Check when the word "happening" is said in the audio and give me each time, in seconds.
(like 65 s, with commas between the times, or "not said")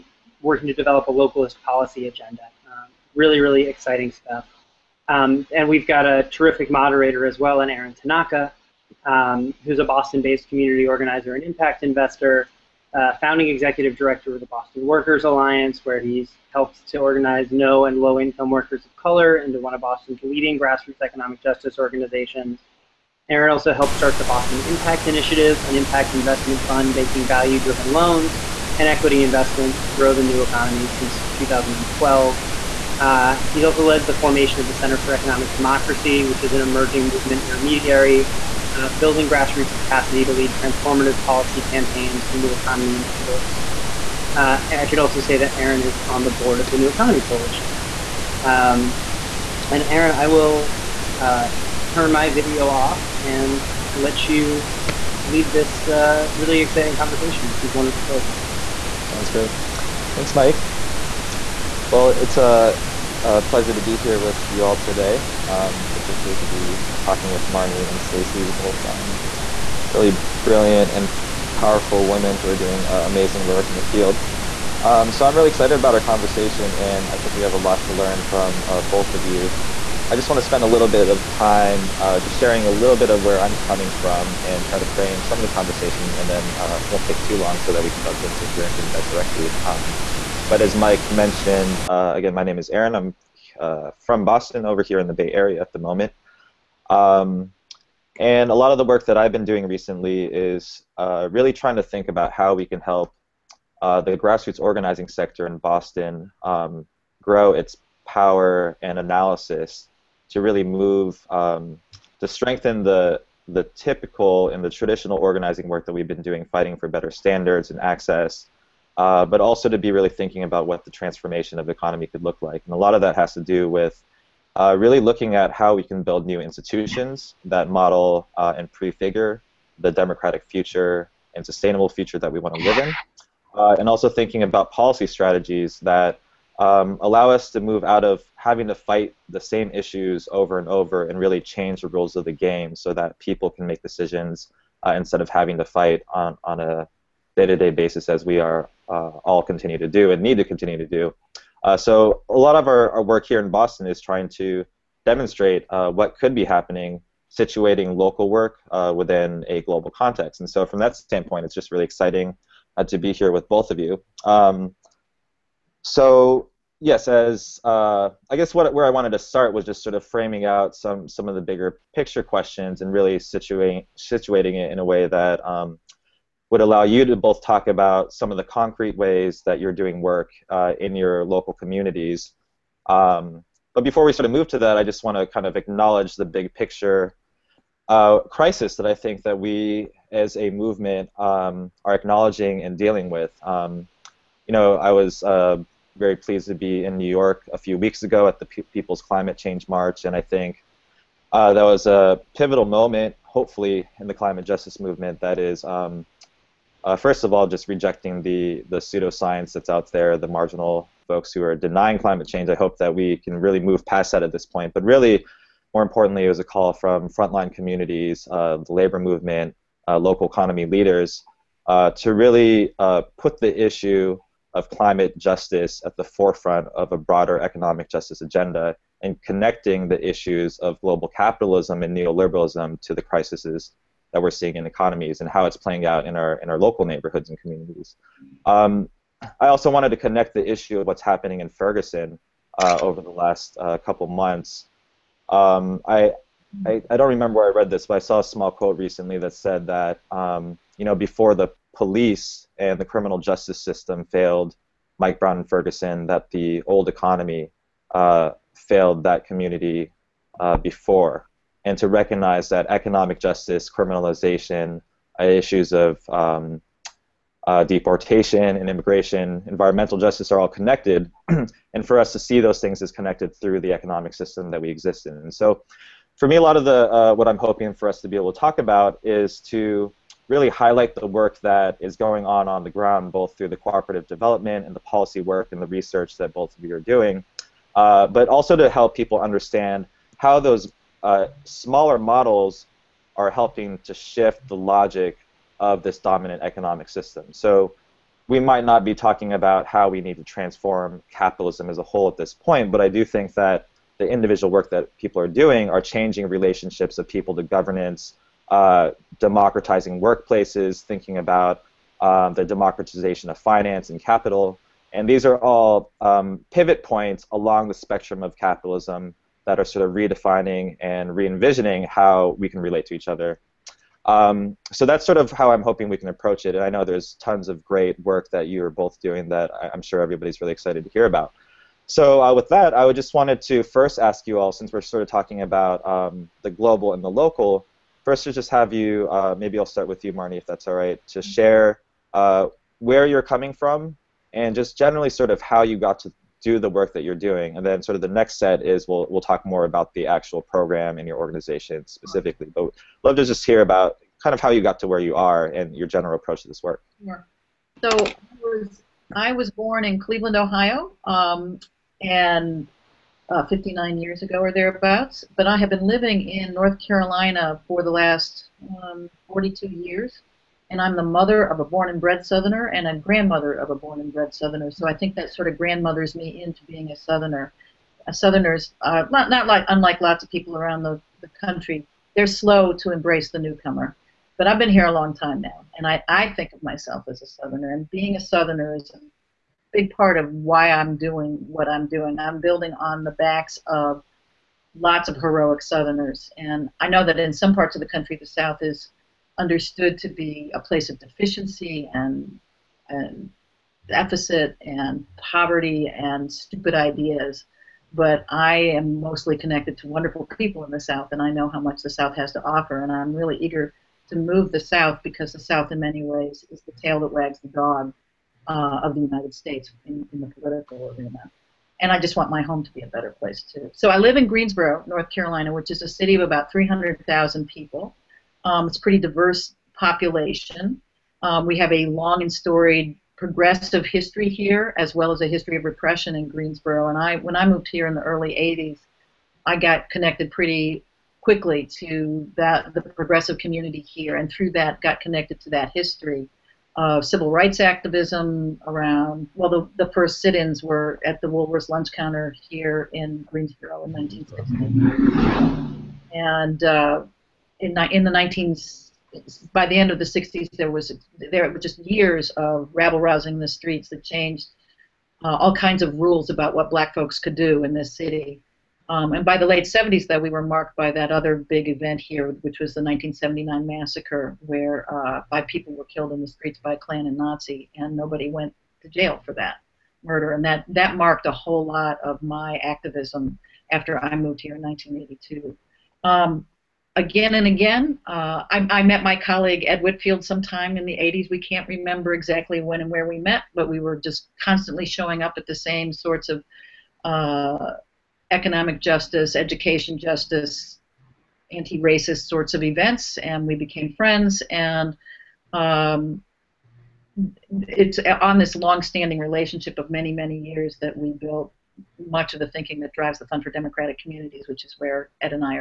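156 s, 241 s.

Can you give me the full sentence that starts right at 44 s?
Uh, I should also say that Aaron is on the board of the New Economy Coalition.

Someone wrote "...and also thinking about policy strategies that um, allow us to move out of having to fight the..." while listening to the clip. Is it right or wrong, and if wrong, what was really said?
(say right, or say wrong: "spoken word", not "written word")
right.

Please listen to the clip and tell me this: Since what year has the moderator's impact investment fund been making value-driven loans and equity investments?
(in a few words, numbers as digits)
2012.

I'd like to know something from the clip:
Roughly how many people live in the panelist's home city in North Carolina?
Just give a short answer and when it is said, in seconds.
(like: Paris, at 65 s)
300,000, at 426 s.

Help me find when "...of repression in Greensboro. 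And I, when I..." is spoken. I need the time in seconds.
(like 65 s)
435 s.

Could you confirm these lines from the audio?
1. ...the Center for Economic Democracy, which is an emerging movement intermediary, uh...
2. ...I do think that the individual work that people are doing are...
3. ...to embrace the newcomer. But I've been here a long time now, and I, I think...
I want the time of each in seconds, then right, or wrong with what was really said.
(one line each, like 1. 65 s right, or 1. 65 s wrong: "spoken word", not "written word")
1. 34 s right
2. 302 s right
3. 382 s right.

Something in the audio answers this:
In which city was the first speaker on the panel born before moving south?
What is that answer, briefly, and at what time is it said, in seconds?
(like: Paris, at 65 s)
Cleveland, Ohio, at 359 s.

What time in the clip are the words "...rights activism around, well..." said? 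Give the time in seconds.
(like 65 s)
447 s.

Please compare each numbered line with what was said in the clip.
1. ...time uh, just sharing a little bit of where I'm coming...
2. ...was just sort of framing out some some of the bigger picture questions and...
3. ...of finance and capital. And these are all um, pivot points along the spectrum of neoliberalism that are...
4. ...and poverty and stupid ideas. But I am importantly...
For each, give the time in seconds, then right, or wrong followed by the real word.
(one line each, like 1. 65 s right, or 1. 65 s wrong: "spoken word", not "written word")
1. 81 s right
2. 169 s right
3. 313 s wrong: "capitalism", not "neoliberalism"
4. 404 s wrong: "mostly", not "importantly".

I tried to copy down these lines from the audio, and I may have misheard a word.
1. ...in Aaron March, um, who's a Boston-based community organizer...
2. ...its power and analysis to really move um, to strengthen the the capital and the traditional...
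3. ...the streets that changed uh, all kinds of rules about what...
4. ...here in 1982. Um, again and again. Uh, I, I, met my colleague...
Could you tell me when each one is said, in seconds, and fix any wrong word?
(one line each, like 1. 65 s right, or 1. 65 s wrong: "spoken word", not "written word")
1. 7 s wrong: "Tanaka", not "March"
2. 107 s wrong: "typical", not "capital"
3. 463 s right
4. 484 s right.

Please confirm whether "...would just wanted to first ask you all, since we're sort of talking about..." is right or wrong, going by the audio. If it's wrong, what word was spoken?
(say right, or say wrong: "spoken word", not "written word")
right.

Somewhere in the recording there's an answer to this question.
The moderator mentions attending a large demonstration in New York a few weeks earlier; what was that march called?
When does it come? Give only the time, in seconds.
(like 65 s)
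198 s.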